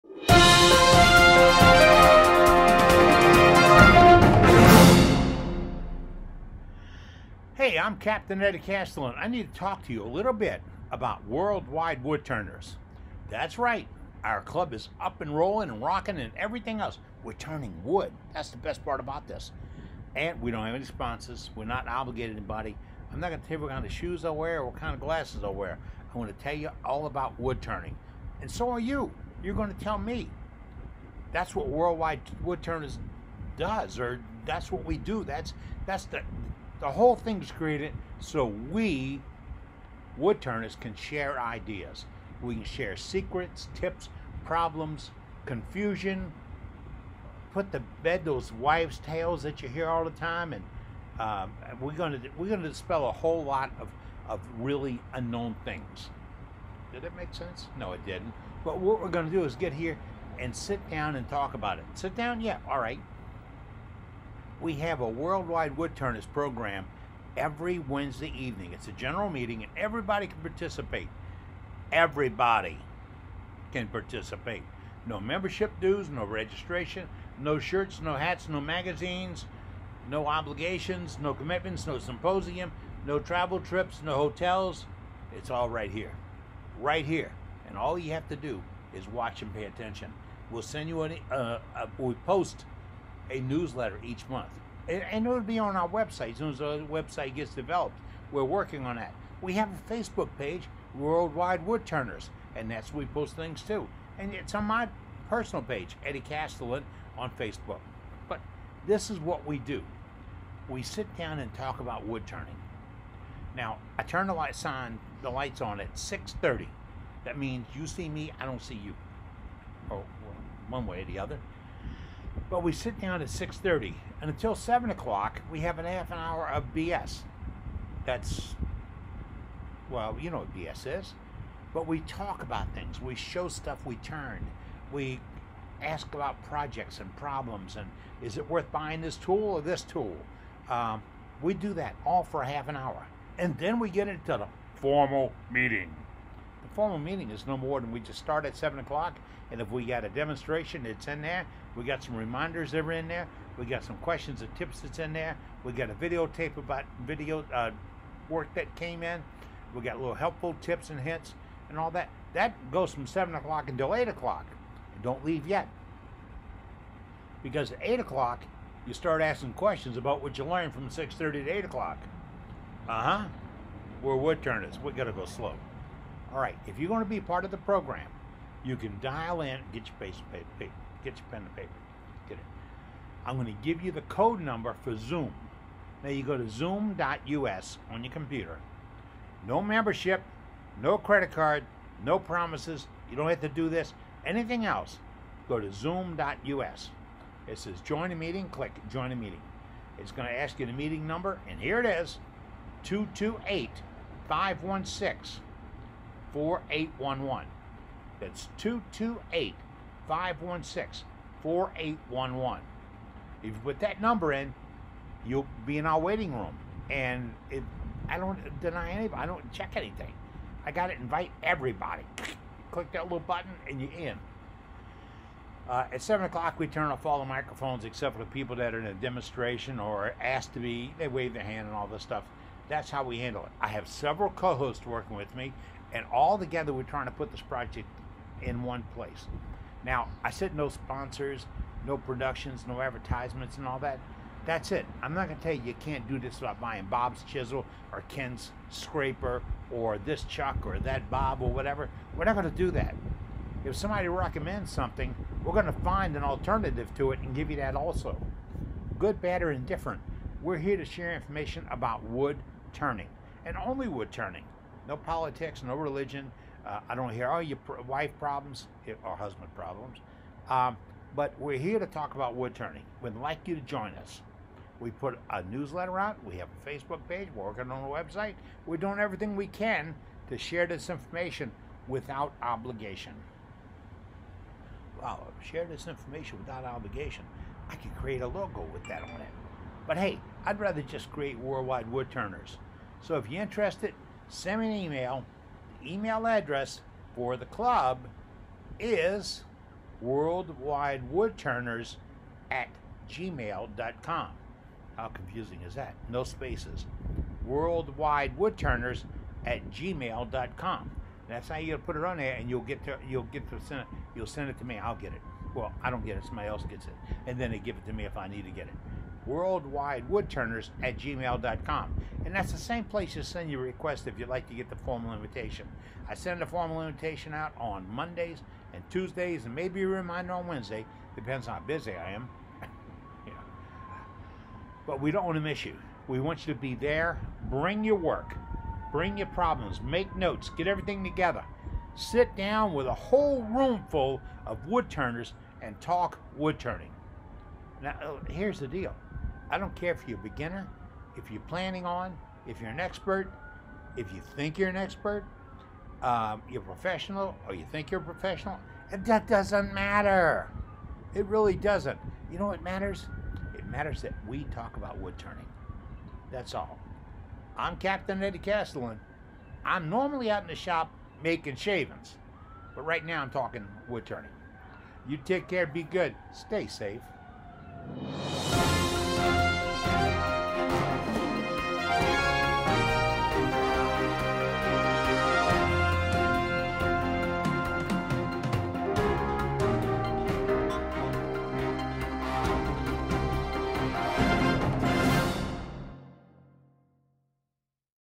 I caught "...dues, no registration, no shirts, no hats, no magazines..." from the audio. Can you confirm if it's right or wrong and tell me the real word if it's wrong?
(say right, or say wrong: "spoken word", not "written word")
right.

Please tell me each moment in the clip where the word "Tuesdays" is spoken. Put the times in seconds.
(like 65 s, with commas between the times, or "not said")
328 s.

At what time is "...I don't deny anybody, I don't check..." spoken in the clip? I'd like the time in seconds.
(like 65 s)
218 s.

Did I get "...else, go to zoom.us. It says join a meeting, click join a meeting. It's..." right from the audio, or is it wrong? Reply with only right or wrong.
right.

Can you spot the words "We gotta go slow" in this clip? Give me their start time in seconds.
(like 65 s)
174 s.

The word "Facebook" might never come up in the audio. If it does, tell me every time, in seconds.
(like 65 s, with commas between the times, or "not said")
99 s, 107 s, 276 s.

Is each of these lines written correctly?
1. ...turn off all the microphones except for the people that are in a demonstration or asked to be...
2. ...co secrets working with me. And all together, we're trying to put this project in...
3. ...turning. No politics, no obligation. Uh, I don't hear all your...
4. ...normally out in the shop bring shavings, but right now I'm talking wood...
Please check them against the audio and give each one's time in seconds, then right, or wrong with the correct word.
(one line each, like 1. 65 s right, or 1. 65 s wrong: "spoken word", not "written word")
1. 226 s right
2. 234 s wrong: "hosts", not "secrets"
3. 264 s wrong: "religion", not "obligation"
4. 369 s wrong: "making", not "bring".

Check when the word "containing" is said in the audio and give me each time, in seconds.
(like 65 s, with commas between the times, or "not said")
not said.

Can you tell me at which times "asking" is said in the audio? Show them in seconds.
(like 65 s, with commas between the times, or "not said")
169 s.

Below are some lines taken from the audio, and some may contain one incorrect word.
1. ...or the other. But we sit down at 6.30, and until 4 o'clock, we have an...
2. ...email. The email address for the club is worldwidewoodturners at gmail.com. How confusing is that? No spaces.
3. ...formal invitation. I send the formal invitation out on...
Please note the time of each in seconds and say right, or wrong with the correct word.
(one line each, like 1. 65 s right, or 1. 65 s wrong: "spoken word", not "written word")
1. 121 s wrong: "7", not "4"
2. 294 s right
3. 324 s right.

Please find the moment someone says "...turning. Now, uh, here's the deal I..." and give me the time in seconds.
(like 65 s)
346 s.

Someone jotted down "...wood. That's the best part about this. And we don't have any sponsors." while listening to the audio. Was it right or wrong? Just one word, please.
right.